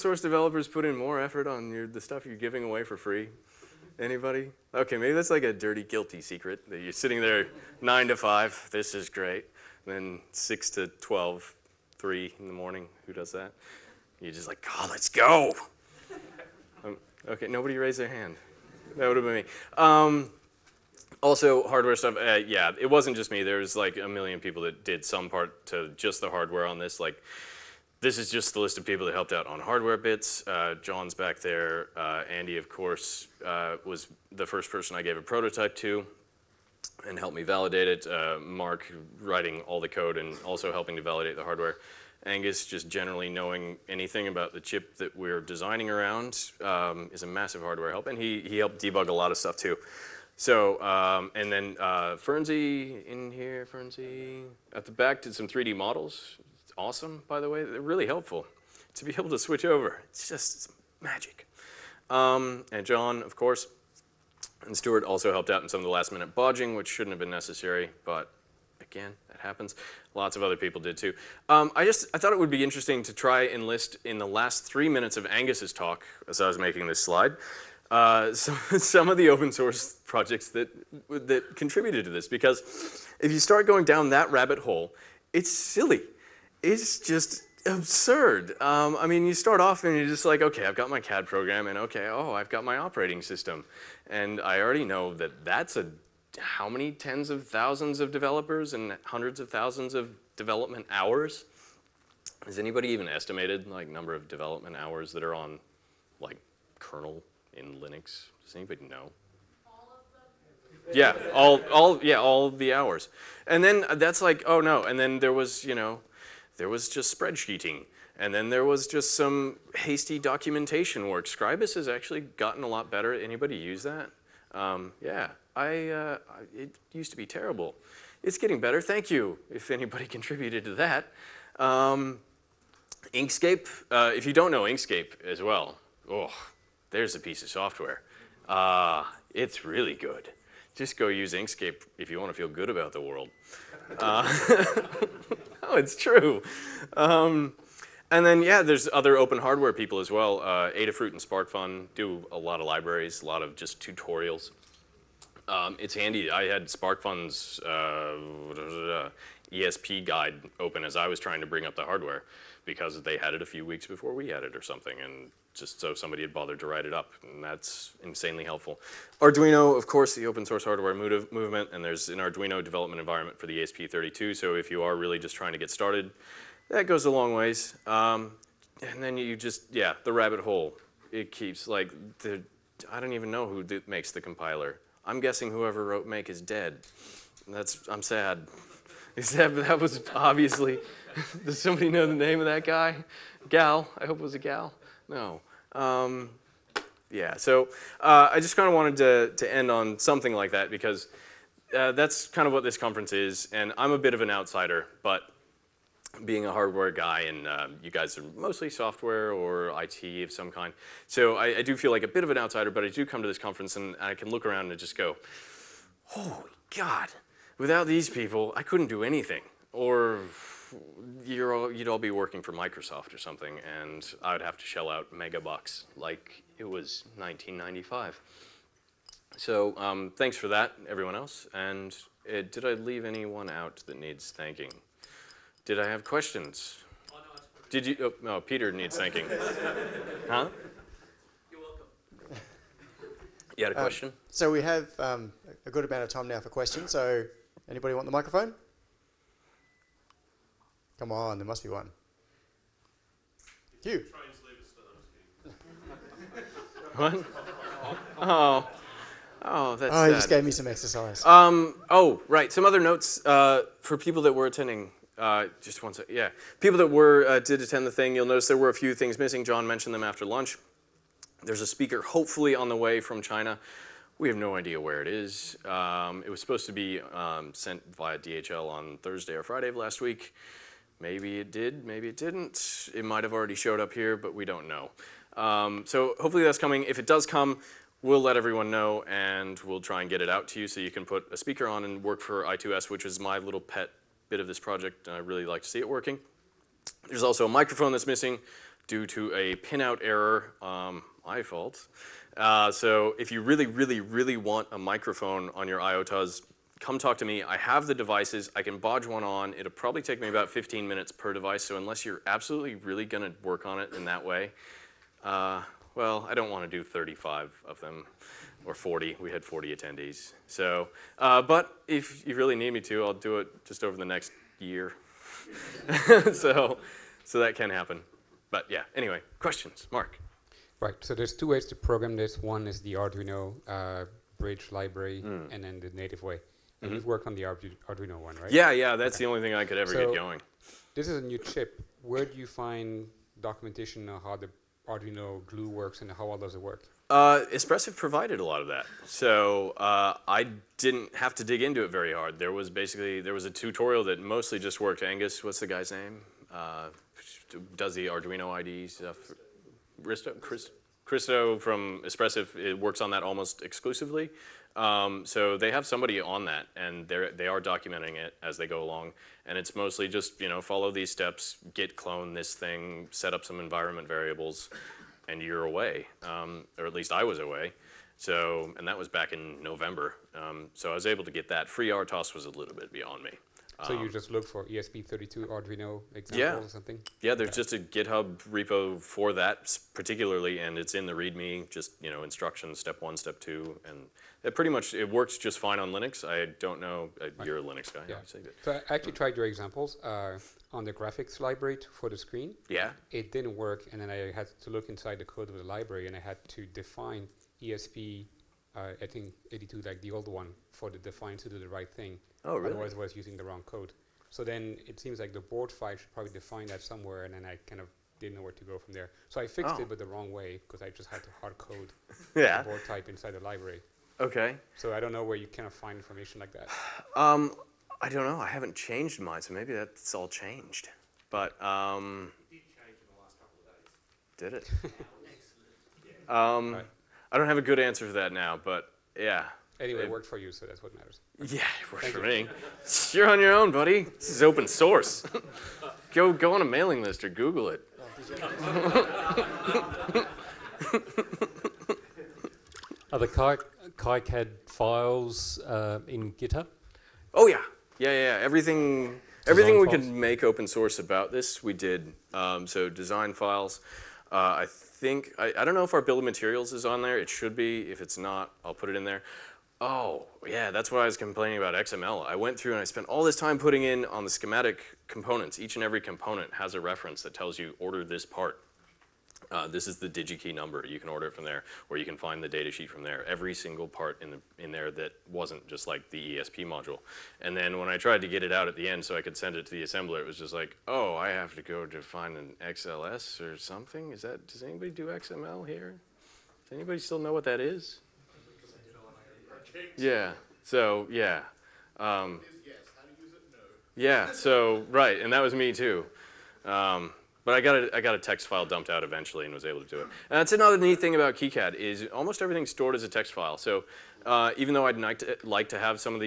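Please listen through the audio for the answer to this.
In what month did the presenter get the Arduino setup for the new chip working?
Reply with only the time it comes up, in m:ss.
6:19.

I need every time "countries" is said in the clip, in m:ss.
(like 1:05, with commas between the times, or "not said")
not said.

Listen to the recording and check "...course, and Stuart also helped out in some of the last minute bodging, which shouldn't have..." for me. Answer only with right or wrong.
right.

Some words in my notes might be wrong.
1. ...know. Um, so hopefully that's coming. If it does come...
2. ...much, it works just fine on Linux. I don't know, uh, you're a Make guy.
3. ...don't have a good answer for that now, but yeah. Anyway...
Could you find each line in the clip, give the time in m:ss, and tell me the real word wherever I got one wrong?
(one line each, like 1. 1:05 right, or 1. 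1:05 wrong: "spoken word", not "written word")
1. 4:44 right
2. 6:34 wrong: "Linux", not "Make"
3. 7:17 right.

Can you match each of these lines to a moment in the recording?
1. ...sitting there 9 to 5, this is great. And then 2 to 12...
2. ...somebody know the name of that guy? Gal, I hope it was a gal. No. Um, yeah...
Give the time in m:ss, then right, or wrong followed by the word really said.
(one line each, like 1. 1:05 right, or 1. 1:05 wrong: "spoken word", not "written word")
1. 0:06 wrong: "6", not "2"
2. 3:11 right.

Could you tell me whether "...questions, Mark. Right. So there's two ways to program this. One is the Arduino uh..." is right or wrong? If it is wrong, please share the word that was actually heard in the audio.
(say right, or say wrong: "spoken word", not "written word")
right.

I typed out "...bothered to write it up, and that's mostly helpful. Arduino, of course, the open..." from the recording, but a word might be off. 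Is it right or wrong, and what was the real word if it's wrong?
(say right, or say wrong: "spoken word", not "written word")
wrong: "insanely", not "mostly".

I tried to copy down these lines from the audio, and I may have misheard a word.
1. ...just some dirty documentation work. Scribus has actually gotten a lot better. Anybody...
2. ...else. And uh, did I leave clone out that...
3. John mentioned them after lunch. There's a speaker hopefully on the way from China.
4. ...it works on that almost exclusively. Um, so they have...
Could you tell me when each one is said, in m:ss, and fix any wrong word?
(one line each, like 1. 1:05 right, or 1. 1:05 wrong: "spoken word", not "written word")
1. 1:58 wrong: "hasty", not "dirty"
2. 3:51 wrong: "anyone", not "clone"
3. 4:29 right
4. 6:02 right.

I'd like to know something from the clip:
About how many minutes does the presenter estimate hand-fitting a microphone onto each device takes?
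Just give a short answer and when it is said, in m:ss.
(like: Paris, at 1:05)
15, at 5:10.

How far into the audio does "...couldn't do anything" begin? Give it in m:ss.
3:38.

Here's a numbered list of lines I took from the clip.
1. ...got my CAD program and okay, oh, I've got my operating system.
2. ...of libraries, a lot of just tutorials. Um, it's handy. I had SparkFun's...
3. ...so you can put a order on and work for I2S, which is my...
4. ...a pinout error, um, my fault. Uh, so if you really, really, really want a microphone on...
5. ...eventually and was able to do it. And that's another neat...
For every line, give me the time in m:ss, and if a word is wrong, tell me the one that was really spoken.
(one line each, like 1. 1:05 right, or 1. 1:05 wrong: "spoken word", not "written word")
1. 1:30 right
2. 2:32 right
3. 4:50 wrong: "speaker", not "order"
4. 4:59 right
5. 8:29 right.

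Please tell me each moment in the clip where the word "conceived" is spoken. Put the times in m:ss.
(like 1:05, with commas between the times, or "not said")
not said.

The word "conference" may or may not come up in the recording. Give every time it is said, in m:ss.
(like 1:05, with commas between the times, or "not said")
3:22, 3:33.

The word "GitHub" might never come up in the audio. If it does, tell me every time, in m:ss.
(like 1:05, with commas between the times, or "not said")
6:27, 7:36.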